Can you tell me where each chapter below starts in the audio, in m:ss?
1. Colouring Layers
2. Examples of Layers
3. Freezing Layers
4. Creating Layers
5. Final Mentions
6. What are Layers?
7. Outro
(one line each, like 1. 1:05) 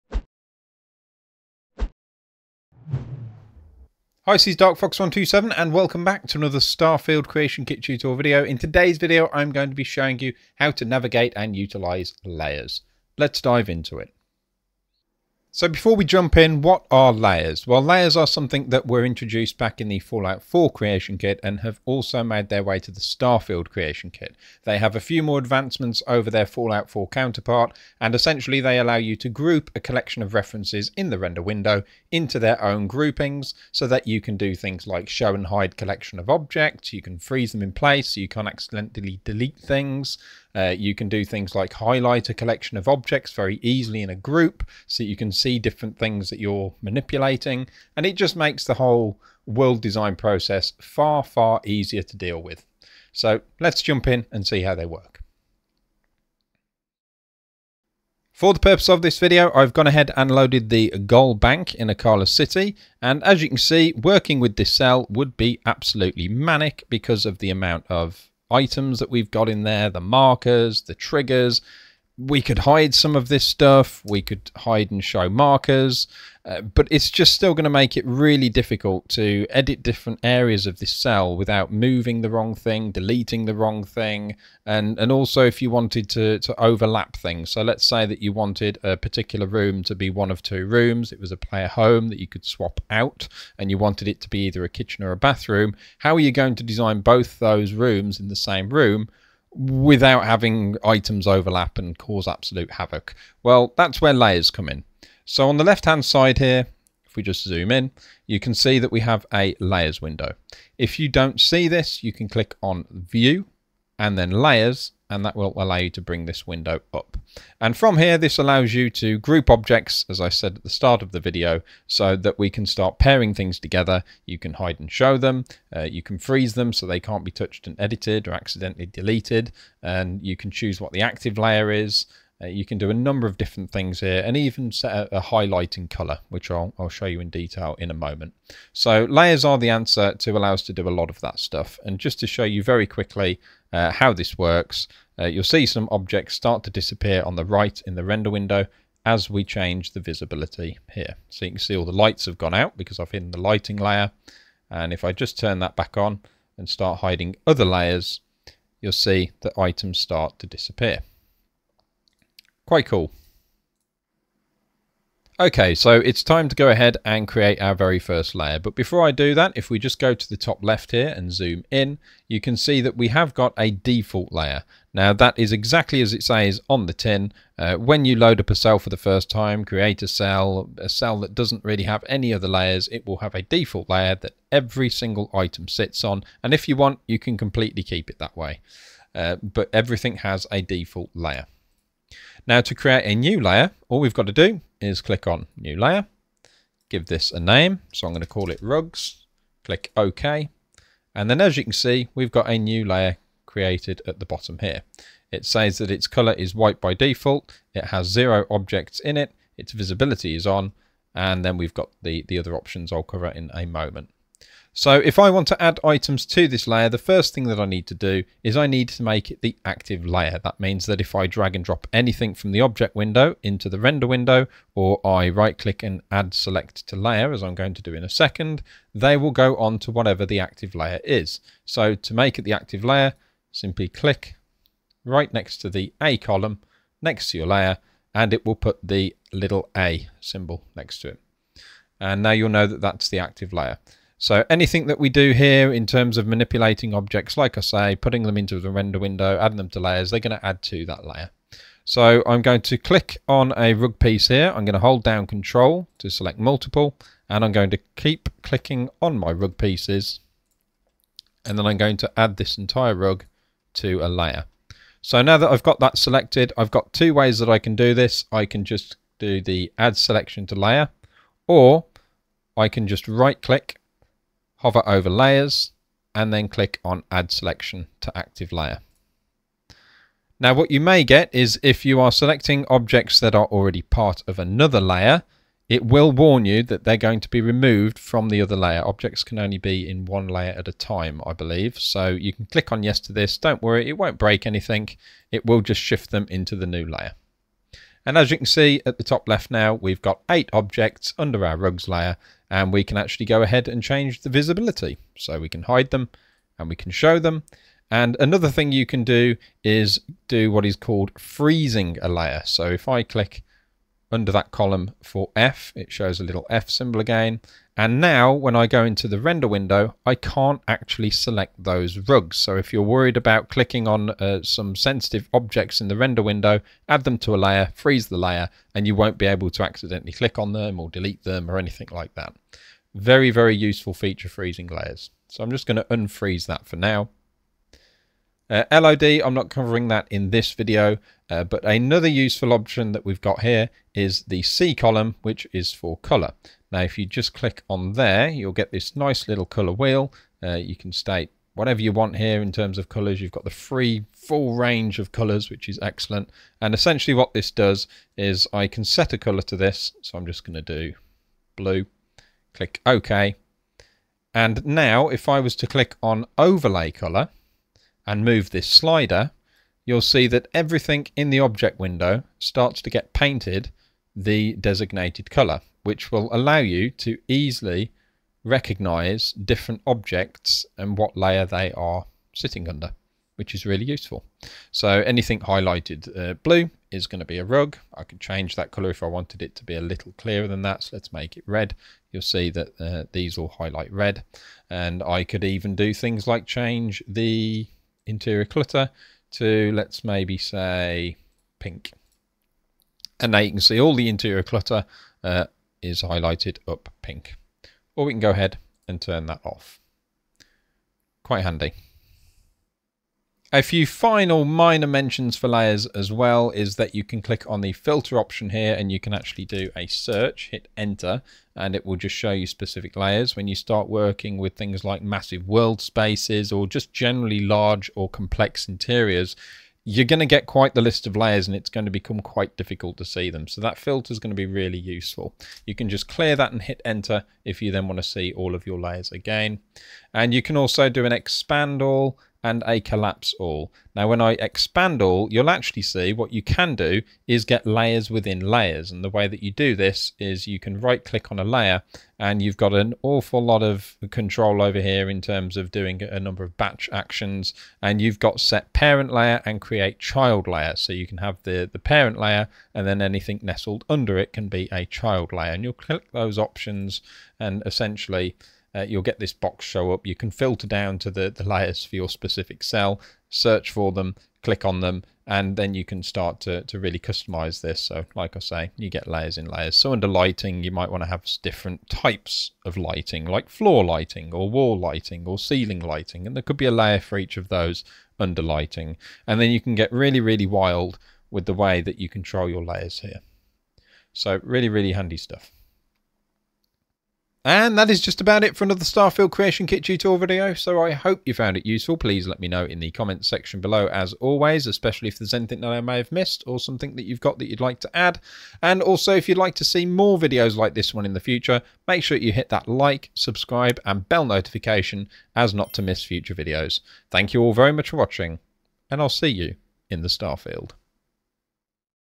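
1. 5:44
2. 0:58
3. 5:12
4. 2:44
5. 6:54
6. 0:15
7. 8:17.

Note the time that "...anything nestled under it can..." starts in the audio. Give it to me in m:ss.
7:43.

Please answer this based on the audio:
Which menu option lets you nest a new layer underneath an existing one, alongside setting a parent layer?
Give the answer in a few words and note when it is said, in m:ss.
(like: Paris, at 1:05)
create child layer, at 7:39.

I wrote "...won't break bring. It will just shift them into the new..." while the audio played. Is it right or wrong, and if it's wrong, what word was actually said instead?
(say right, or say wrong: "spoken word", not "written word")
wrong: "anything", not "bring".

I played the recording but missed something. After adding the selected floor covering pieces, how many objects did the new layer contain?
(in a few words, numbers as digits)
8.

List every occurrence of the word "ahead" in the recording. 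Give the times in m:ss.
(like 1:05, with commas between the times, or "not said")
0:59, 2:46, 5:03, 6:48.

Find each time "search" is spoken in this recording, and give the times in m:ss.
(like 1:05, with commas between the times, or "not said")
6:59, 7:53.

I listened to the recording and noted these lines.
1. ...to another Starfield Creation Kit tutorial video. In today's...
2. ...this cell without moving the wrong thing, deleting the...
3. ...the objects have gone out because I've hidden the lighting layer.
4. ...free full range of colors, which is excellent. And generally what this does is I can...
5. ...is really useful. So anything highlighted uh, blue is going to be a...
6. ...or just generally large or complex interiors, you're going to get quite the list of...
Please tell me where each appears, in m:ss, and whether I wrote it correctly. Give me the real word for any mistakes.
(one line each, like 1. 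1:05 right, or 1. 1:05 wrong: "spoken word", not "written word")
1. 0:06 right
2. 1:20 right
3. 2:31 wrong: "lights", not "objects"
4. 5:53 wrong: "essentially", not "generally"
5. 6:23 right
6. 7:06 right.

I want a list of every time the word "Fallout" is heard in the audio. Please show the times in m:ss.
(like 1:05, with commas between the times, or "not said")
0:19, 0:26.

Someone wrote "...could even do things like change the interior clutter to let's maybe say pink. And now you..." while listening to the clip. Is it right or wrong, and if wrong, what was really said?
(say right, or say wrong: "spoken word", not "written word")
right.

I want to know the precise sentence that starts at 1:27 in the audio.
So let's say that you wanted a particular room to be one of two rooms.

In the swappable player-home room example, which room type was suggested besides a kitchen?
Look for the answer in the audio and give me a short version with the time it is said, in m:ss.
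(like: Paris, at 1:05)
bathroom, at 1:35.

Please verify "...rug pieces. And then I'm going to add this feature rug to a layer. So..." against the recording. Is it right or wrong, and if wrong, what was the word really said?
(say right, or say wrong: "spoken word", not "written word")
wrong: "entire", not "feature".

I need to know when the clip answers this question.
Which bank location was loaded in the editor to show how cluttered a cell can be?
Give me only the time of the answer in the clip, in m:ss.
1:00.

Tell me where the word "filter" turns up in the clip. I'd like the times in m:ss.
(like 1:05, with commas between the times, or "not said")
6:57, 7:13, 7:50.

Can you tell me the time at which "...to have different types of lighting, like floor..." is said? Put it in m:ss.
8:01.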